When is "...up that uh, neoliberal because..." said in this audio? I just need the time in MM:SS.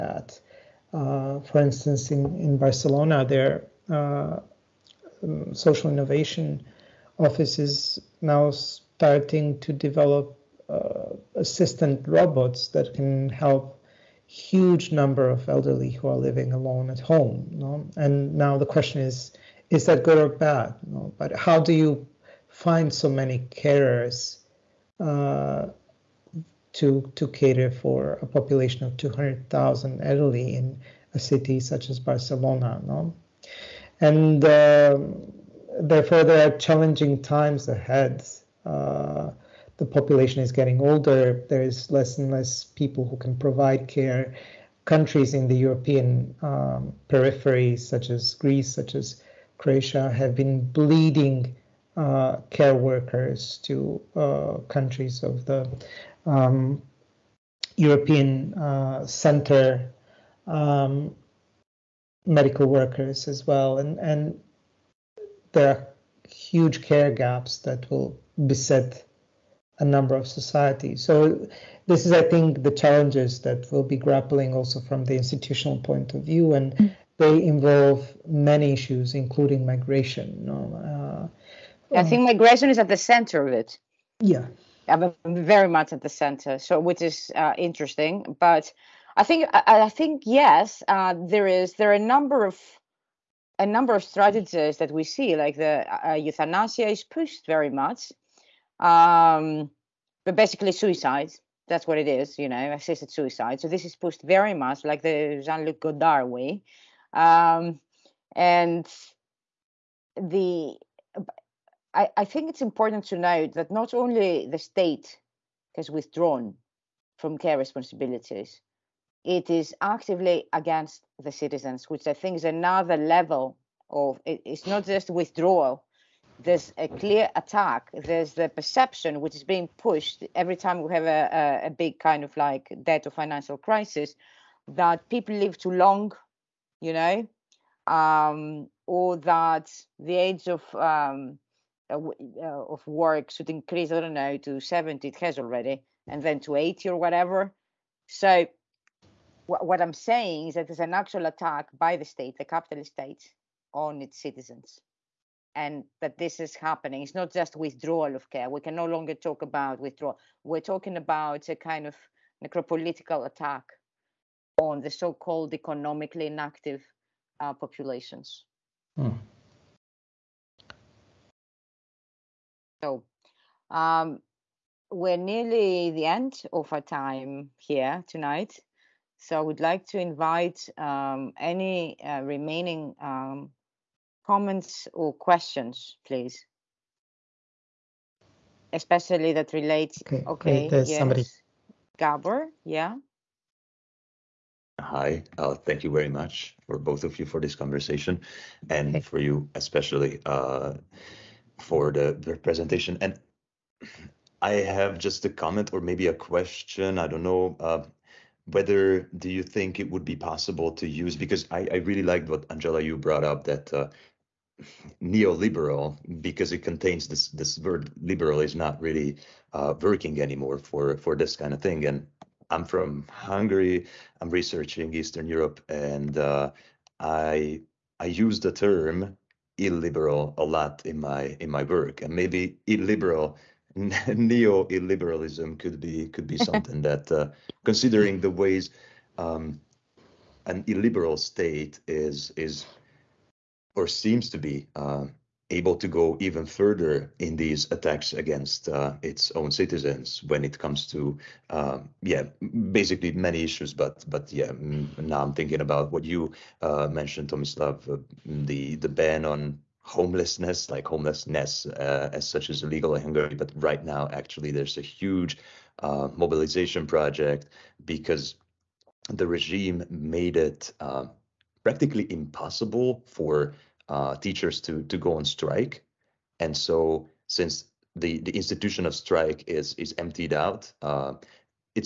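03:33.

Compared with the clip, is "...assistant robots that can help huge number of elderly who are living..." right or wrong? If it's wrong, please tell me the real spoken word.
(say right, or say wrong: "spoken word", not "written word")
right.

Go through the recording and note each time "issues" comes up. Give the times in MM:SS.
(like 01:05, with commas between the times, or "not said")
01:18, 04:13.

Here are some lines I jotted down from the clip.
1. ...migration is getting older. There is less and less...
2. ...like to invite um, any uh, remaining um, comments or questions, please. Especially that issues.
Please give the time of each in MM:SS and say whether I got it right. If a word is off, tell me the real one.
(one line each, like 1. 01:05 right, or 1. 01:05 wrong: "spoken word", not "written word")
1. 00:39 wrong: "population", not "migration"
2. 02:59 wrong: "relates", not "issues".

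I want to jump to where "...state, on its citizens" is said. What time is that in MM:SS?
02:32.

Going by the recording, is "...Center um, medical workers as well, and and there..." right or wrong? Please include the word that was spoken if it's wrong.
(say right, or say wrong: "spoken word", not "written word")
right.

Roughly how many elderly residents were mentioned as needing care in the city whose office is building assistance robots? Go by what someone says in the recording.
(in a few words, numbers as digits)
200,000.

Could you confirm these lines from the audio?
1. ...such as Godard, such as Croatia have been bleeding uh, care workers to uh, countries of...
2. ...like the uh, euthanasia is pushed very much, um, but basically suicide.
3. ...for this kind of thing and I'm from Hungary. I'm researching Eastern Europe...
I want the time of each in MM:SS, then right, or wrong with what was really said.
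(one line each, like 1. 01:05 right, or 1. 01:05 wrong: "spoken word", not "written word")
1. 00:47 wrong: "Greece", not "Godard"
2. 01:35 right
3. 03:40 right.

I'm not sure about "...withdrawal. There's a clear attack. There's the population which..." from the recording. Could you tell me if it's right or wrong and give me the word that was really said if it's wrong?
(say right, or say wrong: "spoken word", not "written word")
wrong: "perception", not "population".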